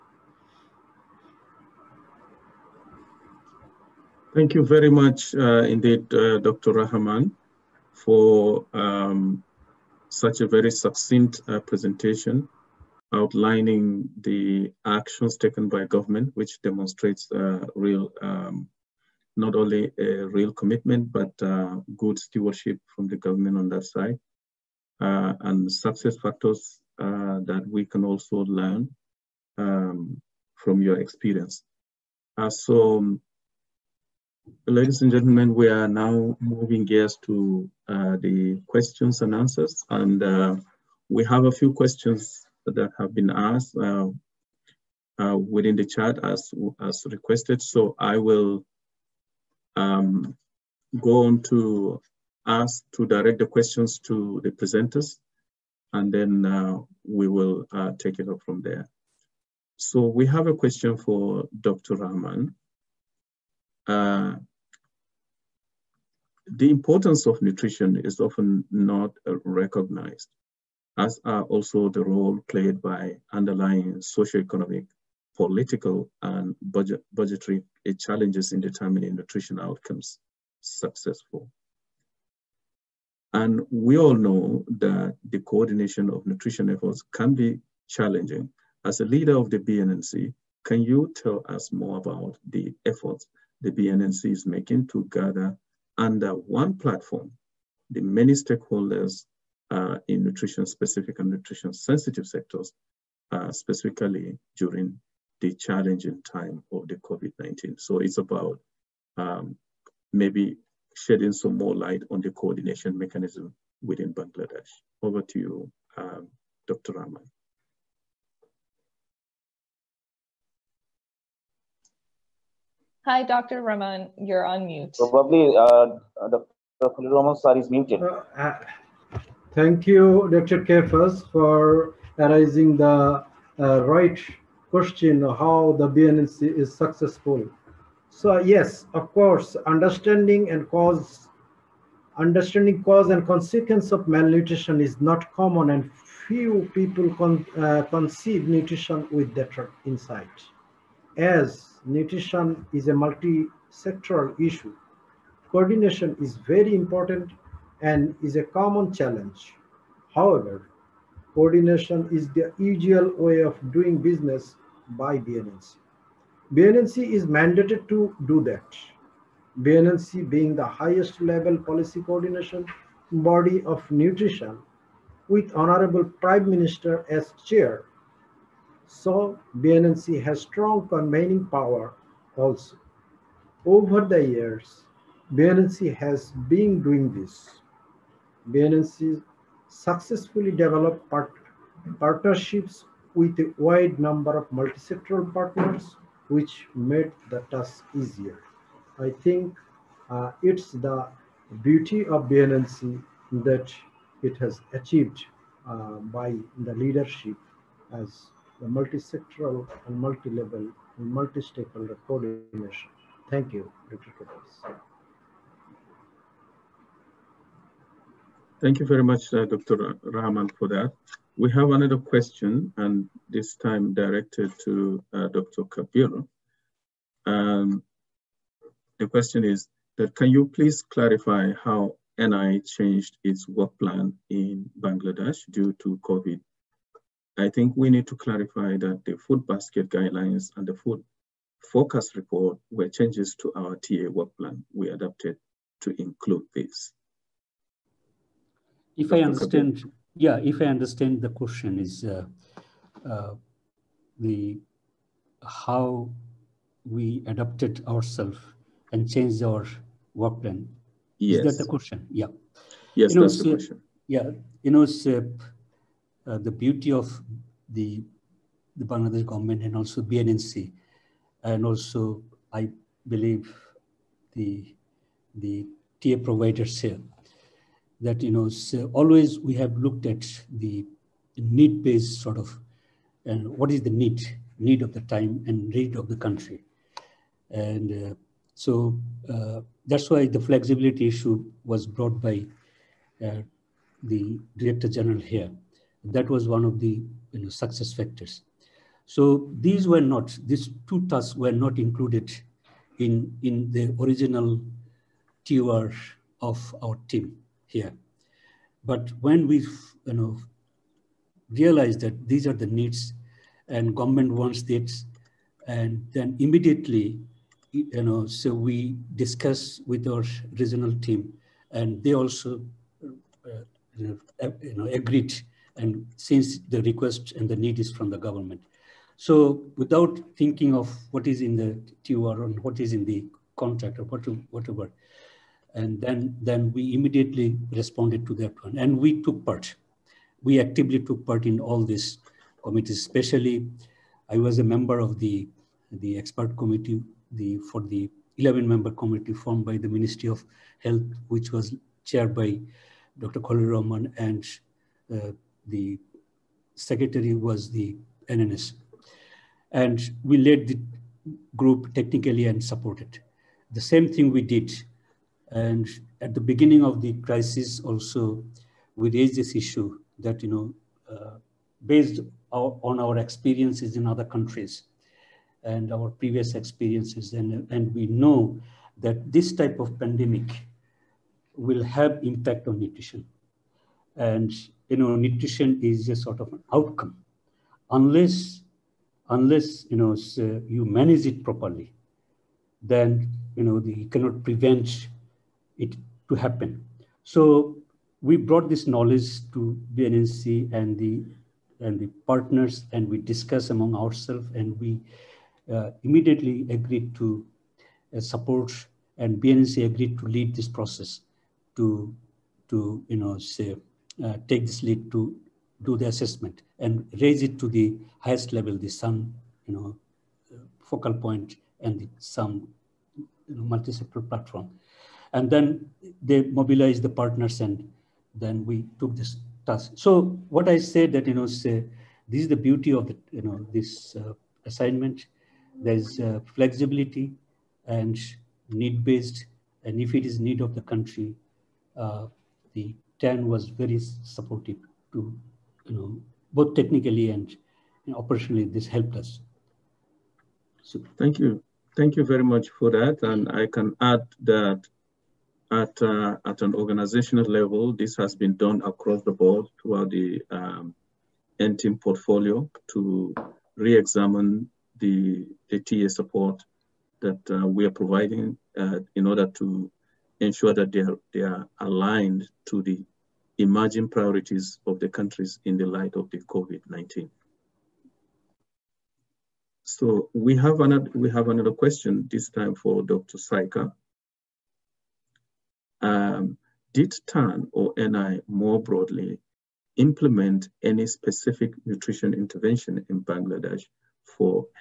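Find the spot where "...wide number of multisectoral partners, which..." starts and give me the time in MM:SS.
03:13.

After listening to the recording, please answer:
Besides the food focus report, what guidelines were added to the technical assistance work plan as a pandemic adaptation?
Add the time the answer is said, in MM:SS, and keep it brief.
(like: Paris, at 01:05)
food basket guidelines, at 03:59.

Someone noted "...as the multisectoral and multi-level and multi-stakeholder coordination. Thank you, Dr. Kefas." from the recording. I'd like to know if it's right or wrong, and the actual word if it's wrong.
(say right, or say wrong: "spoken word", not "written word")
right.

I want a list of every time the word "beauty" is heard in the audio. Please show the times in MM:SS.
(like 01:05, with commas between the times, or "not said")
03:21, 04:26, 07:12.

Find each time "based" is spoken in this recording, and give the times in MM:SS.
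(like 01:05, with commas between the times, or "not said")
04:41, 06:11, 07:18.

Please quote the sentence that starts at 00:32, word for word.
so um, Ladies and gentlemen, we are now moving gears to uh, the questions and answers.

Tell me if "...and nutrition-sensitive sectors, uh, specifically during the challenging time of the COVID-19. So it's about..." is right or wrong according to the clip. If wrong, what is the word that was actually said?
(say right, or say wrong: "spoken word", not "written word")
right.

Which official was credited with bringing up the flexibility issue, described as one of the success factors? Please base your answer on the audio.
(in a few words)
the director general.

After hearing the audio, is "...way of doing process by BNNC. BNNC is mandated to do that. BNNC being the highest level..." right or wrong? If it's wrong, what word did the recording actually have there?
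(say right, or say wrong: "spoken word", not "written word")
wrong: "business", not "process".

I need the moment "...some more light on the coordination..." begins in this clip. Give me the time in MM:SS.
01:51.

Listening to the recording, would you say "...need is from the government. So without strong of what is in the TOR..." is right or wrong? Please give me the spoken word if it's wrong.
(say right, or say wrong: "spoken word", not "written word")
wrong: "thinking", not "strong".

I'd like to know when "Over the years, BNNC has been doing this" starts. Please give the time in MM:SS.
03:03.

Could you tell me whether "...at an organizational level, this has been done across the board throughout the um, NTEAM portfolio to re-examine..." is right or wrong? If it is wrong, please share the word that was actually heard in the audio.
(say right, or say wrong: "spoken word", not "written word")
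right.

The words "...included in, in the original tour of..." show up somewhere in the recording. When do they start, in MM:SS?
05:01.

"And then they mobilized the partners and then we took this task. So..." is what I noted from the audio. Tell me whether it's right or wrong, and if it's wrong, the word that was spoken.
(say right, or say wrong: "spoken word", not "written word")
right.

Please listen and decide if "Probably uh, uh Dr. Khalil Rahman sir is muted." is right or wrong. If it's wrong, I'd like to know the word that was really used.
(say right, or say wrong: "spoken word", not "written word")
right.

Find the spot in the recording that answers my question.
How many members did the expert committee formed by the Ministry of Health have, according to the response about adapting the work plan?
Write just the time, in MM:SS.
05:48.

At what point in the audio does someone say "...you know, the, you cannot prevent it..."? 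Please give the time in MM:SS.
06:33.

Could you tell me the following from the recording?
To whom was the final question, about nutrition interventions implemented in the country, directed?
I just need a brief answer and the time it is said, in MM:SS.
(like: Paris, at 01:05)
Dr. Saiqa, at 08:03.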